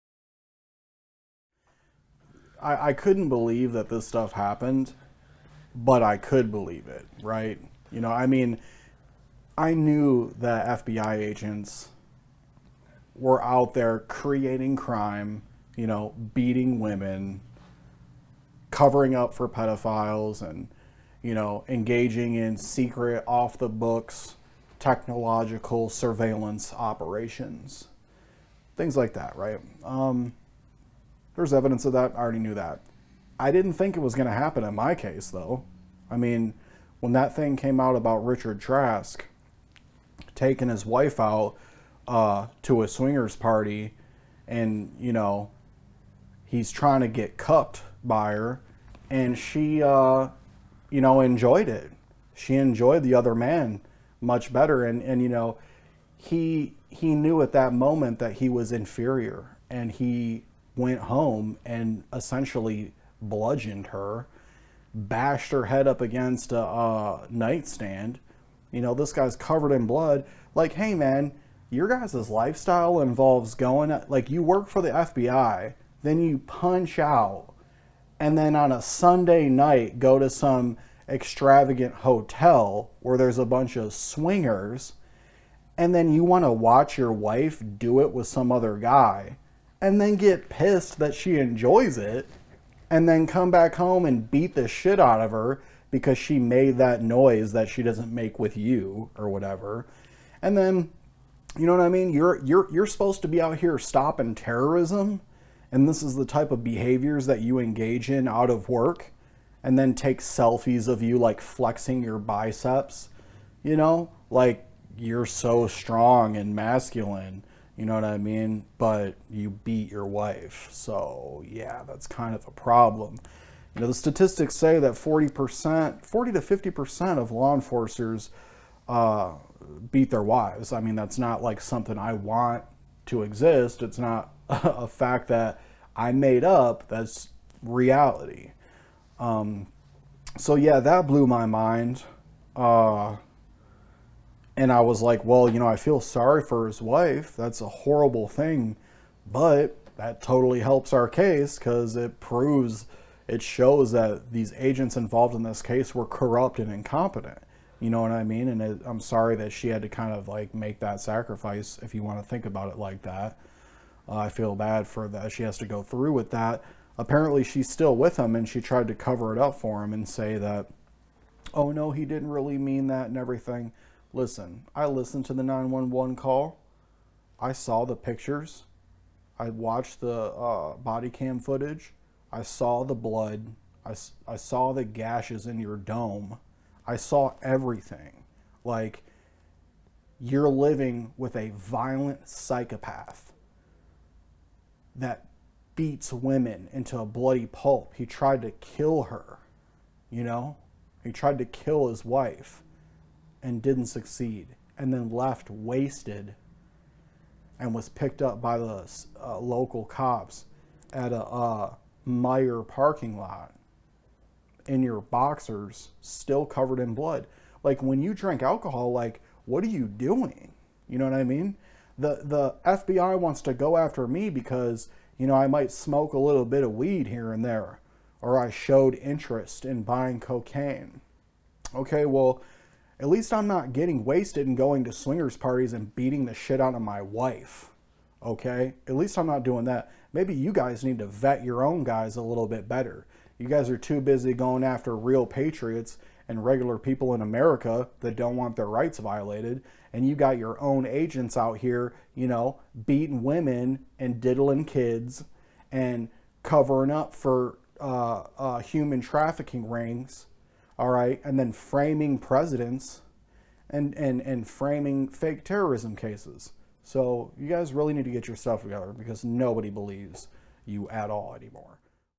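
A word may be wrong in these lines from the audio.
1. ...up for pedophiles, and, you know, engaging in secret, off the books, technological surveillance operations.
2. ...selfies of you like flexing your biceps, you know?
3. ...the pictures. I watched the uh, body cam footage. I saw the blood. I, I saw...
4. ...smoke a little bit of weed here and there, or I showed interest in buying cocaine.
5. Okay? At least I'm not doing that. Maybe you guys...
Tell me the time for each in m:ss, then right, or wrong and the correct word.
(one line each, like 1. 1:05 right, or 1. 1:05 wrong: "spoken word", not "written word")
1. 0:19 right
2. 1:50 right
3. 2:57 right
4. 3:45 right
5. 3:58 right.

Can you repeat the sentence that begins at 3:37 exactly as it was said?
Like when you drink alcohol, like what are you doing?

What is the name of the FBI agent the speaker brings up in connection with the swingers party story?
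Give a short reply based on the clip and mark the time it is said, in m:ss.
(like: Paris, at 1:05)
Richard Trask, at 0:38.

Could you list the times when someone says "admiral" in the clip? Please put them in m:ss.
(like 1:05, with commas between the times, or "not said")
not said.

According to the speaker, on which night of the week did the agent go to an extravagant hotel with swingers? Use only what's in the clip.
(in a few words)
Sunday night.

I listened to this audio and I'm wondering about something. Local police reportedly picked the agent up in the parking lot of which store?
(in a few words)
Meijer.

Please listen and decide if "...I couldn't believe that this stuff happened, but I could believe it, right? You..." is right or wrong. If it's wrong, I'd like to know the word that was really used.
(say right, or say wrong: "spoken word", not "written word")
right.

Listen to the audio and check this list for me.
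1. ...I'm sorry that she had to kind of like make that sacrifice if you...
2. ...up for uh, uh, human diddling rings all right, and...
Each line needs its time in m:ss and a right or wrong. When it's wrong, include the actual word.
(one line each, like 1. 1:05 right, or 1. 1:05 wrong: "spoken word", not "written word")
1. 2:38 right
2. 4:16 wrong: "trafficking", not "diddling".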